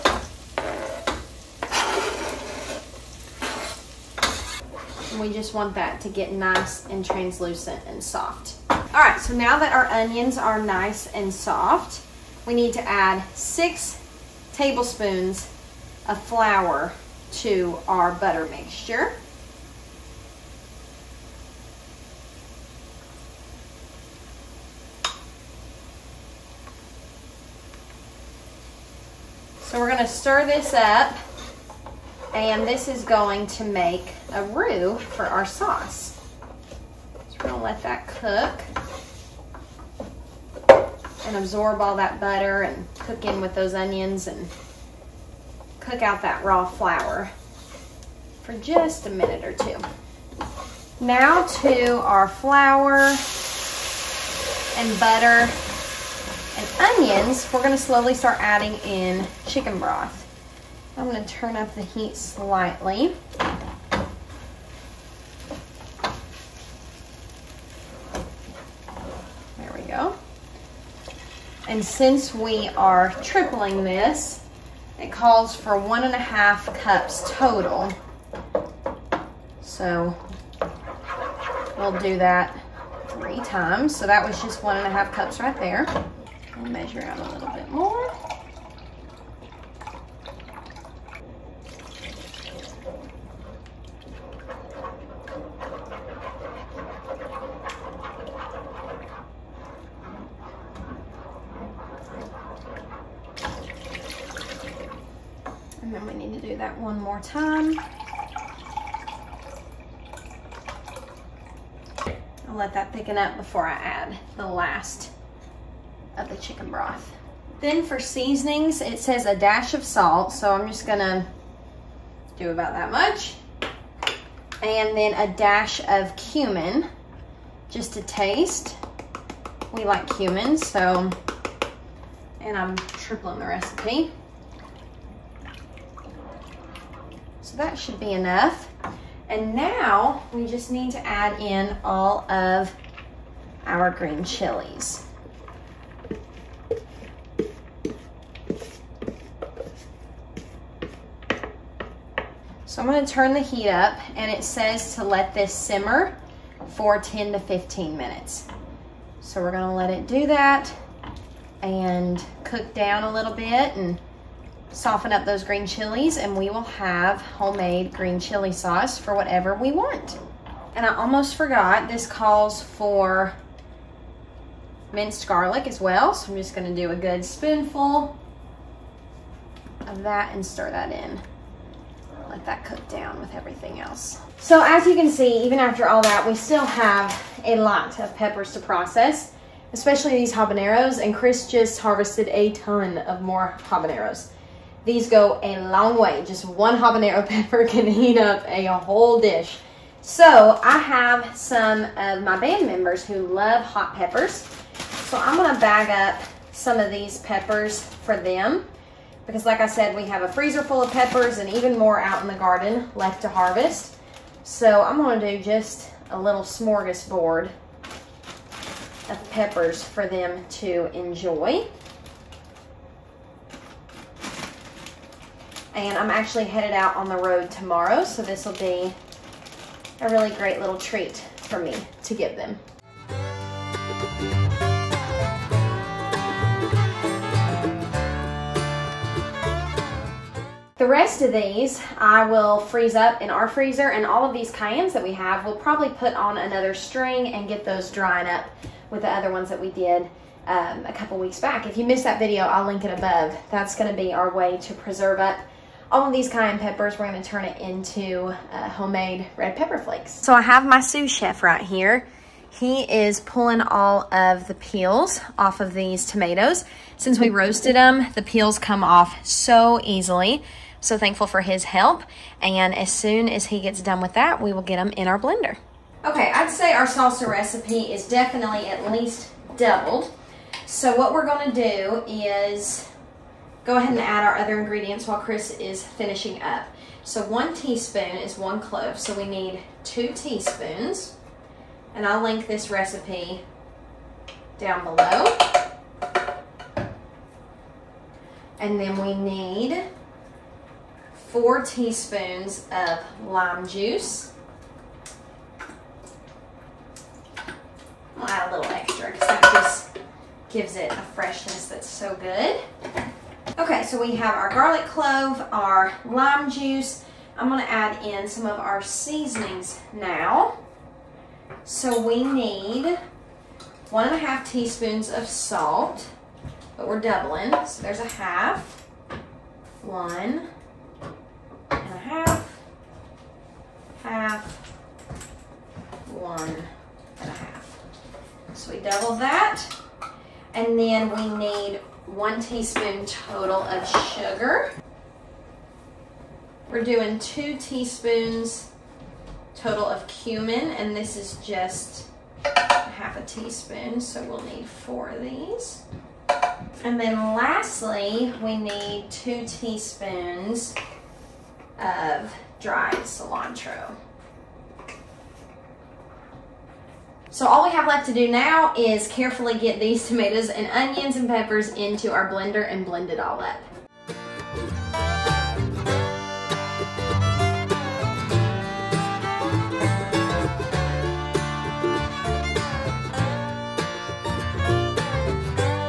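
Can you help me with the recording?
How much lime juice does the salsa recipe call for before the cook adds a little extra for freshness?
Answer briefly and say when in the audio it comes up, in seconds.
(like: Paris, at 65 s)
4 teaspoons, at 301 s.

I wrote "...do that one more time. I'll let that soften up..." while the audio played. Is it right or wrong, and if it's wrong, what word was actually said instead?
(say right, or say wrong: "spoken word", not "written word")
wrong: "thicken", not "soften".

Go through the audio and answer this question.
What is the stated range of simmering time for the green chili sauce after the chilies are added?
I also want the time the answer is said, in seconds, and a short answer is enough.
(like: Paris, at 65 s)
10 to 15 minutes, at 156 s.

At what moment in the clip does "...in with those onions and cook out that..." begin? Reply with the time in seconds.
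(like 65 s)
43 s.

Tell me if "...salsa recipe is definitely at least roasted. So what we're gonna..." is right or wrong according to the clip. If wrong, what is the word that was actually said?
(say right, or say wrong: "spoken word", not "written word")
wrong: "doubled", not "roasted".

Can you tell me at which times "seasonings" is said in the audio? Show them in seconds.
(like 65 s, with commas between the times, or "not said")
117 s, 318 s.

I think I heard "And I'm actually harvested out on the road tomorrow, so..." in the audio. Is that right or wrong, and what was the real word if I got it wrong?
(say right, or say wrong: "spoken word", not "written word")
wrong: "headed", not "harvested".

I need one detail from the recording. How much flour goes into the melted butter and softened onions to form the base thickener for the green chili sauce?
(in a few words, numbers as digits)
6 tablespoons.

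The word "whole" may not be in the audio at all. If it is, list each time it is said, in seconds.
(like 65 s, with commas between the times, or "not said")
198 s.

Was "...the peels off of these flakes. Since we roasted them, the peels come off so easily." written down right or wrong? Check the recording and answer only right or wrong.
wrong.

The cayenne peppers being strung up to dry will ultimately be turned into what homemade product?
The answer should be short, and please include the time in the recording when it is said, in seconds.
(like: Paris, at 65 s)
red pepper flakes, at 259 s.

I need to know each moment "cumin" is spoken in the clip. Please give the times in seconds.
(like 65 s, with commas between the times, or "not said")
126 s, 130 s, 350 s.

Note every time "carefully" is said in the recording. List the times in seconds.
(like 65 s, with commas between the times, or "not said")
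369 s.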